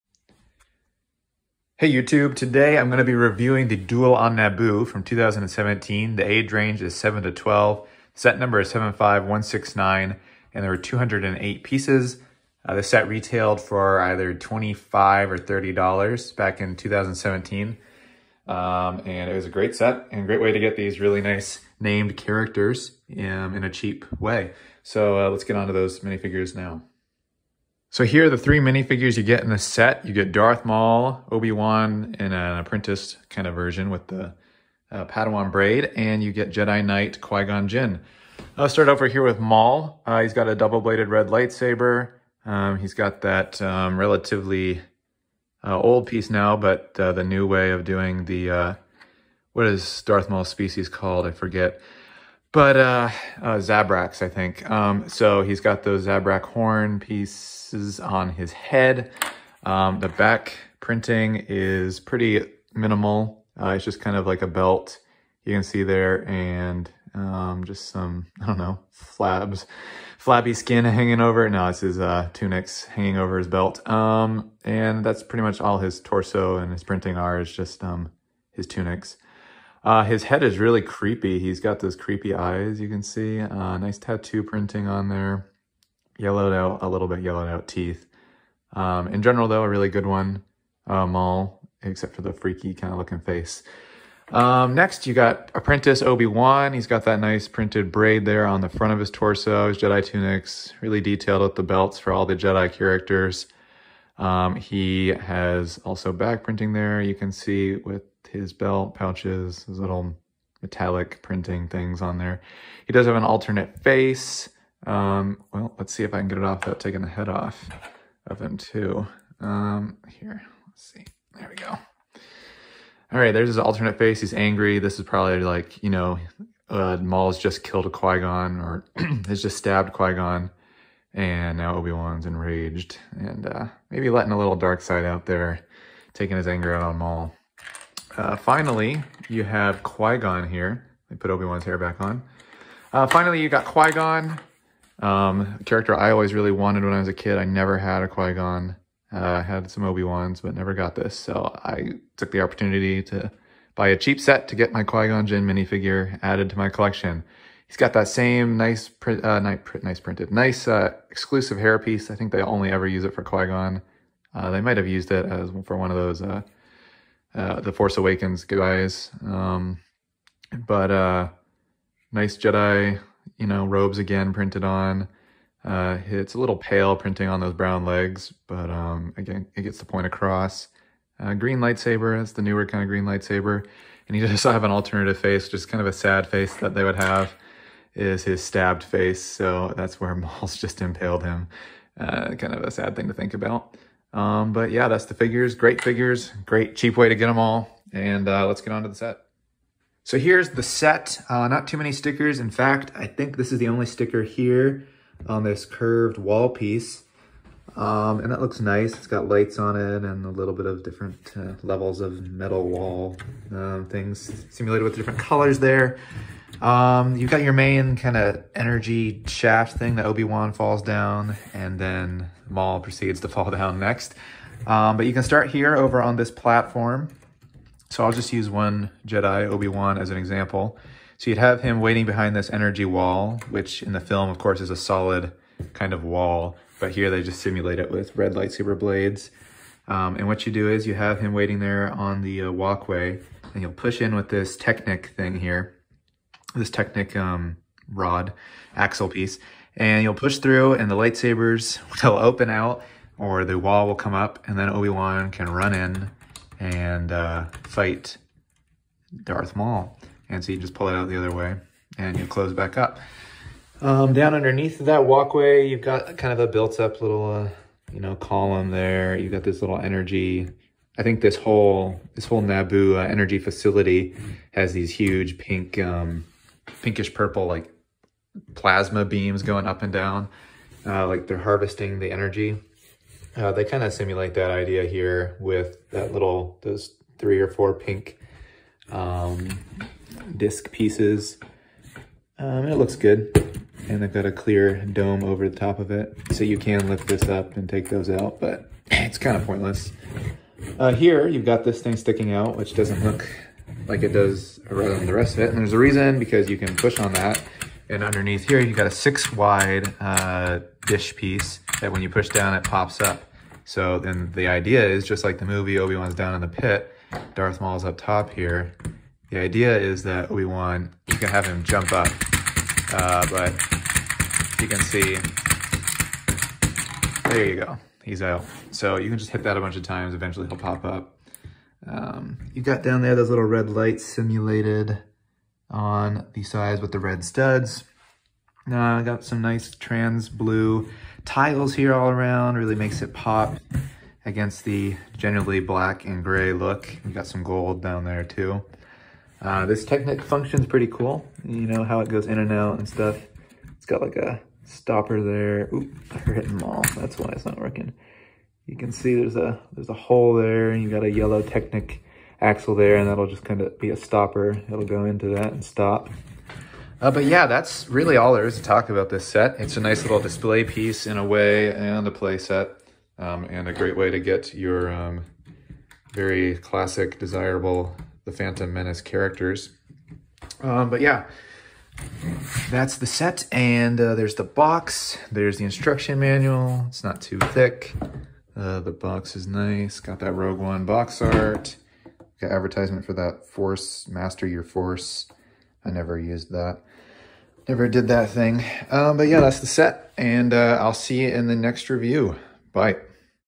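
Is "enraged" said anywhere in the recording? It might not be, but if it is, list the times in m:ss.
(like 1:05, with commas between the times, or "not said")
2:12.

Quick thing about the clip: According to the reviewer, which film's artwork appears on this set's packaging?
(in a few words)
Rogue One.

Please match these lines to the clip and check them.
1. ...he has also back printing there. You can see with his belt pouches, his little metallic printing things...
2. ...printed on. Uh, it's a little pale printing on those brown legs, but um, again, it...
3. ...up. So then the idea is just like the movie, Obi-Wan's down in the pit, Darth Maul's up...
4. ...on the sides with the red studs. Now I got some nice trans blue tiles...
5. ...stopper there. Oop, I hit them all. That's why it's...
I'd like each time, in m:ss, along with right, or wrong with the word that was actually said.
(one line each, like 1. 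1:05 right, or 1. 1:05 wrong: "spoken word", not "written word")
1. 1:44 right
2. 2:54 right
3. 5:13 right
4. 5:35 right
5. 5:54 right.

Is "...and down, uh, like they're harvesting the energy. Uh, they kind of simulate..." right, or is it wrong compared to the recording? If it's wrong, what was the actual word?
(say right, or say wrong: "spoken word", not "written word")
right.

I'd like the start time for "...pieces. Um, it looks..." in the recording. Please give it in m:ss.
4:50.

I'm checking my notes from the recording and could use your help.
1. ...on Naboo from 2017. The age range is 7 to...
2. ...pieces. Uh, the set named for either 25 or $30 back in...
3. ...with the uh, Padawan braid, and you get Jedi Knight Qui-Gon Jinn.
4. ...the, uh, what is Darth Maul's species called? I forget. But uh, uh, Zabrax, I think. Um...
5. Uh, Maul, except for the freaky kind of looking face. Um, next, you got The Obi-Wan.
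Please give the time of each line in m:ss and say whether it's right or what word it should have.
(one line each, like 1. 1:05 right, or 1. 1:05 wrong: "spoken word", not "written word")
1. 0:04 right
2. 0:11 wrong: "retailed", not "named"
3. 0:33 right
4. 0:48 right
5. 1:30 wrong: "Apprentice", not "The".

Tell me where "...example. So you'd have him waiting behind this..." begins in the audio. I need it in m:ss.
3:50.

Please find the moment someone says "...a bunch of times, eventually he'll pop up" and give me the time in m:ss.
5:29.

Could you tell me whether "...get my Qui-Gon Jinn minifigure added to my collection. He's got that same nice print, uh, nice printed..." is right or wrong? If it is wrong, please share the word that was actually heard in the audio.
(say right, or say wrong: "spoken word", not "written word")
right.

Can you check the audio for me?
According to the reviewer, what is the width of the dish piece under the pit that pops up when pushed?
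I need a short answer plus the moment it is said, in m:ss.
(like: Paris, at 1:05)
6 wide, at 5:08.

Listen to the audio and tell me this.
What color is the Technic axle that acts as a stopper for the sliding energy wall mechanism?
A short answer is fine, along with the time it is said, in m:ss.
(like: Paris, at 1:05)
Yellow, at 6:01.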